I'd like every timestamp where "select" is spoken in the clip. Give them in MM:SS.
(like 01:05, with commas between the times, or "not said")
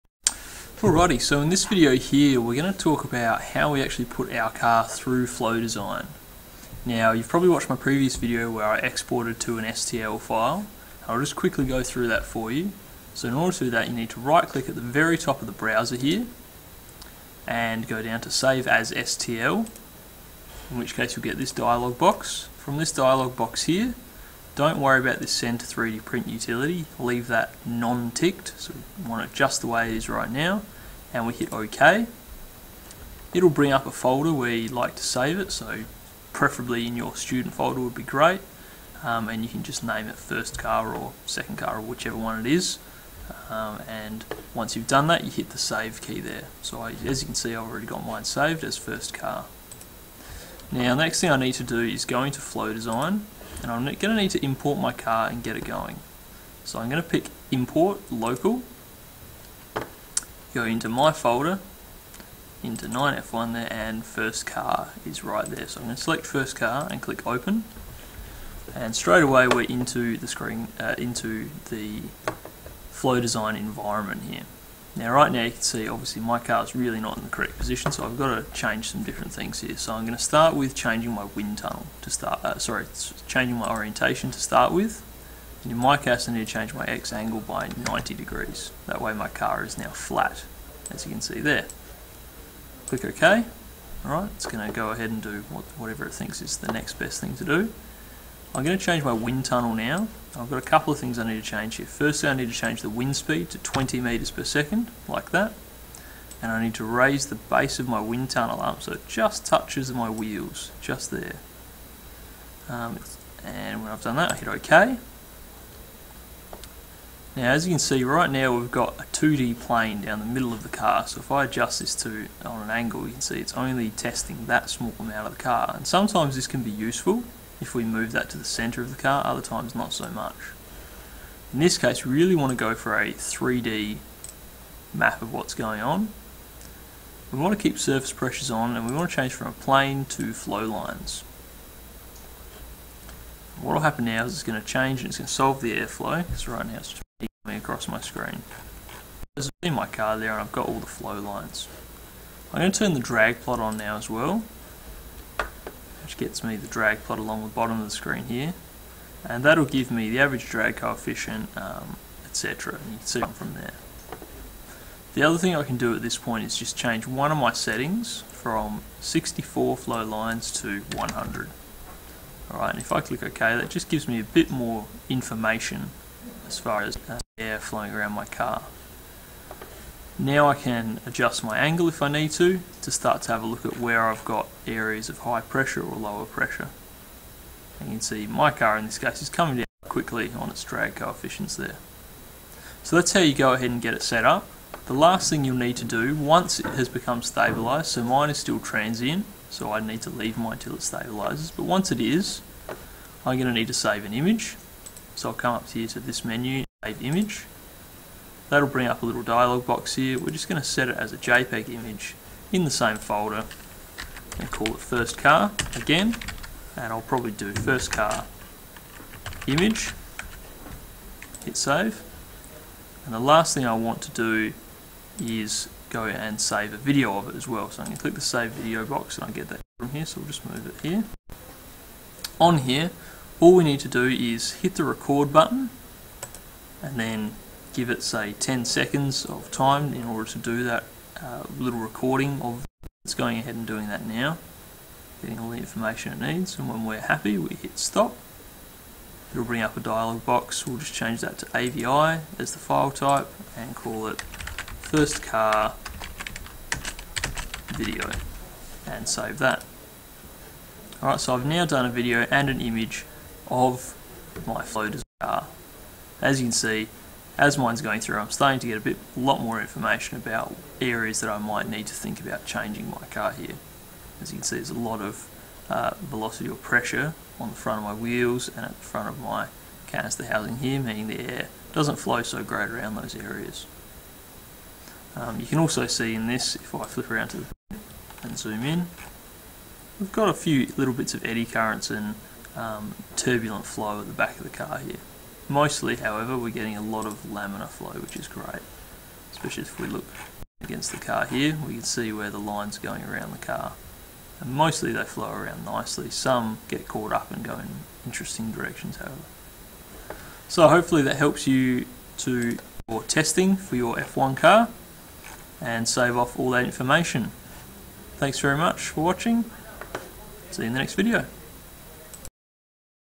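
01:06.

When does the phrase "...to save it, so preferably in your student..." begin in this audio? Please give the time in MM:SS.
00:34.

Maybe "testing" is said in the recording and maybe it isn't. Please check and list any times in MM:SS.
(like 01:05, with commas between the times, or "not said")
02:03, 05:13.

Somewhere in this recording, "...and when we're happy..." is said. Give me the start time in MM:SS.
04:06.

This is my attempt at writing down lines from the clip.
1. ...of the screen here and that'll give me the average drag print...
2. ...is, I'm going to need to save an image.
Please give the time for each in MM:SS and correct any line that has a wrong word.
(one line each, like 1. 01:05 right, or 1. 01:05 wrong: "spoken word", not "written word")
1. 02:37 wrong: "coefficient", not "print"
2. 03:21 right.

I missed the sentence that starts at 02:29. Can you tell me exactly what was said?
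There's in my car there and I've got all the flow lines.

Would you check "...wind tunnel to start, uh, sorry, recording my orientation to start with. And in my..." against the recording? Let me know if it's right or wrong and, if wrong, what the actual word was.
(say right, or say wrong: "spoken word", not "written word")
wrong: "changing", not "recording".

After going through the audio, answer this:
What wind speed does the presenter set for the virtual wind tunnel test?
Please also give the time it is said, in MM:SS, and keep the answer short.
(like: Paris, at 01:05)
20 metres per second, at 01:43.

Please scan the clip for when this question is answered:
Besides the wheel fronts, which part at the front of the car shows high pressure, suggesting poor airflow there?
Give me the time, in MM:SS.
04:39.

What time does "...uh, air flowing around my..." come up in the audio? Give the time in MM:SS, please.
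02:57.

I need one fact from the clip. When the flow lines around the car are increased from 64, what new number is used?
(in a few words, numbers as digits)
100.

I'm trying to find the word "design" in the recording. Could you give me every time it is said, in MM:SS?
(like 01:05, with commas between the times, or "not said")
00:05, 00:52, 01:13.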